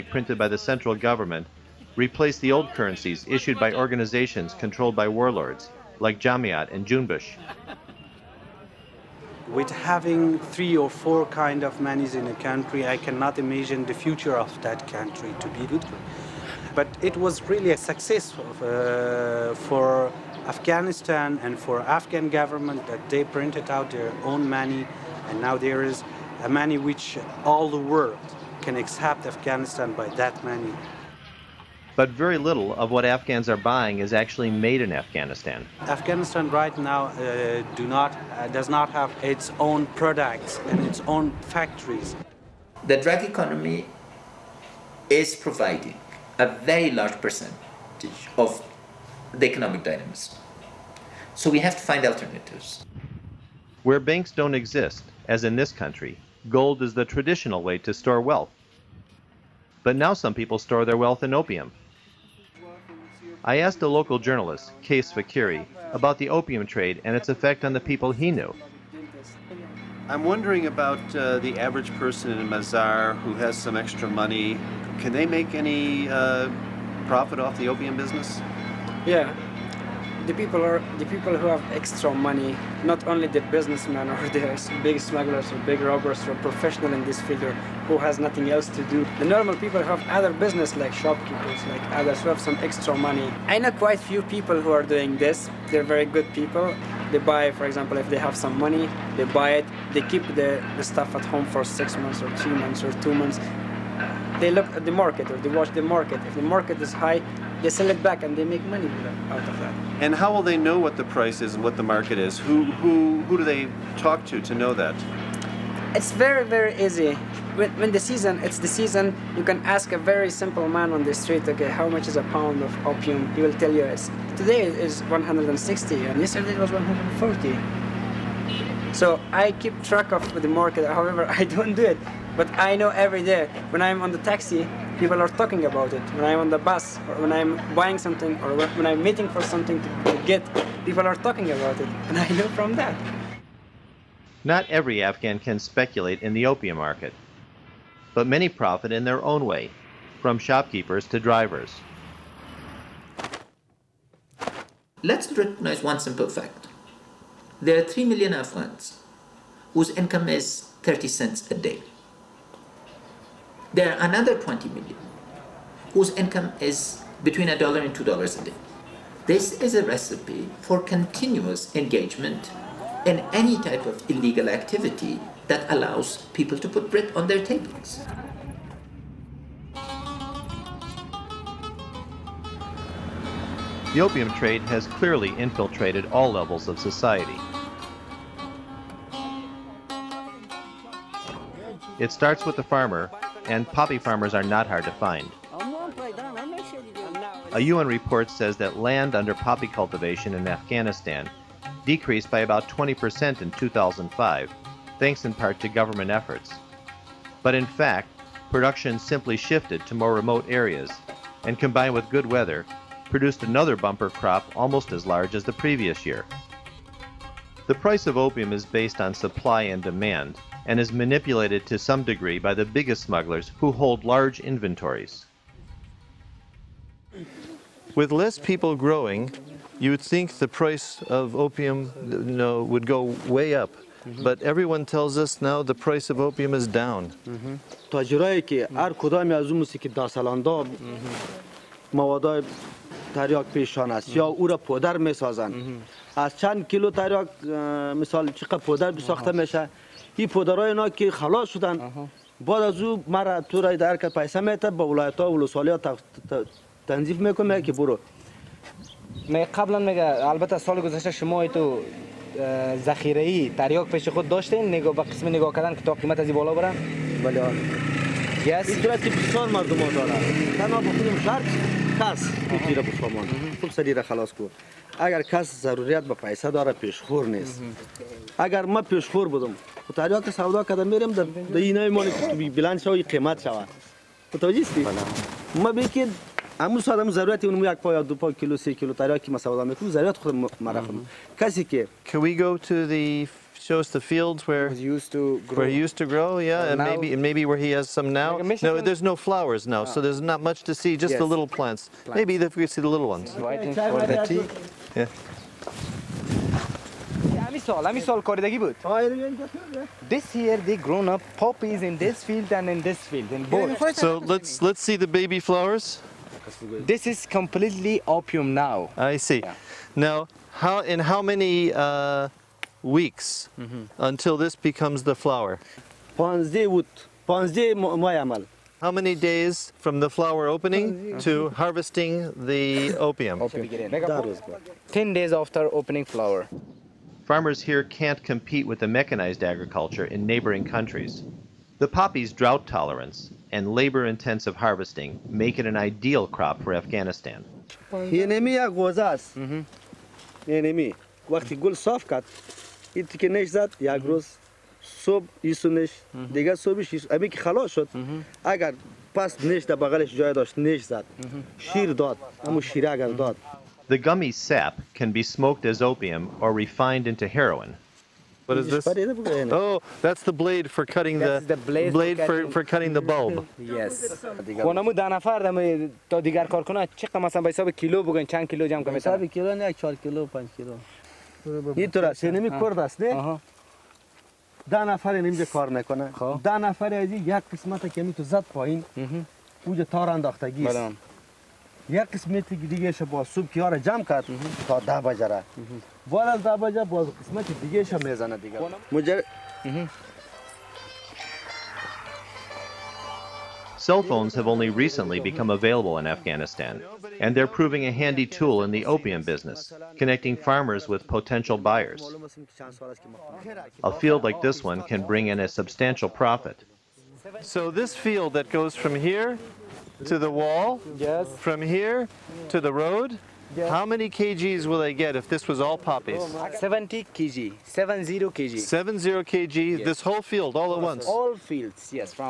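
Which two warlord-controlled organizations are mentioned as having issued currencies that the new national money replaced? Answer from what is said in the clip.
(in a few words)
Jamiat and Junbish.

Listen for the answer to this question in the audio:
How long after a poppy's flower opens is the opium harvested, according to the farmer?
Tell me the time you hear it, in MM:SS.
05:34.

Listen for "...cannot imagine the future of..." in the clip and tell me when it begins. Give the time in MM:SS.
00:12.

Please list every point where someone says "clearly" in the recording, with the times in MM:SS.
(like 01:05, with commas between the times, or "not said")
03:04.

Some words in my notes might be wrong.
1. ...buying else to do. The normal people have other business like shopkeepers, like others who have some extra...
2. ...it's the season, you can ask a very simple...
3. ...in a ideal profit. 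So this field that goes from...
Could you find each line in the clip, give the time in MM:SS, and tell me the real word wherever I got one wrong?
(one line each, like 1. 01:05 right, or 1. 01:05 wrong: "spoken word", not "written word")
1. 01:28 wrong: "nothing", not "buying"
2. 01:58 right
3. 06:55 wrong: "substantial", not "ideal".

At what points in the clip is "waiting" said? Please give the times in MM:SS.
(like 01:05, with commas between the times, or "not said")
02:19.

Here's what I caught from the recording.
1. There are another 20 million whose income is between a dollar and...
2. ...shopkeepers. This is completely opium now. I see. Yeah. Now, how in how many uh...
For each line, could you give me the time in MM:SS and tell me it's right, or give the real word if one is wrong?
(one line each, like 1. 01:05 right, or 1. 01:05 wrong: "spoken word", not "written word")
1. 02:43 right
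2. 05:15 wrong: "flowers", not "shopkeepers".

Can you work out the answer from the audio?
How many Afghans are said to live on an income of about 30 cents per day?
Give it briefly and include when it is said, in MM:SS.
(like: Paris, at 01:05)
3 million, at 02:37.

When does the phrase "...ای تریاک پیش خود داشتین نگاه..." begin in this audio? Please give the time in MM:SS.
04:23.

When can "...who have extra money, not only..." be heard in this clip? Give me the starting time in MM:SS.
01:21.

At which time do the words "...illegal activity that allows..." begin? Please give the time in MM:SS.
02:54.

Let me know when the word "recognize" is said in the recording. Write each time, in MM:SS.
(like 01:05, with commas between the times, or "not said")
02:35.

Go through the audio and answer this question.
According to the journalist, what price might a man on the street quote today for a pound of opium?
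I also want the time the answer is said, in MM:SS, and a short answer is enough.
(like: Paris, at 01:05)
160, at 02:05.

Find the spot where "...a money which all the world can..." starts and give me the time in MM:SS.
00:26.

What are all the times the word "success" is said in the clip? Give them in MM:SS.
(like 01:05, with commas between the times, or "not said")
00:17.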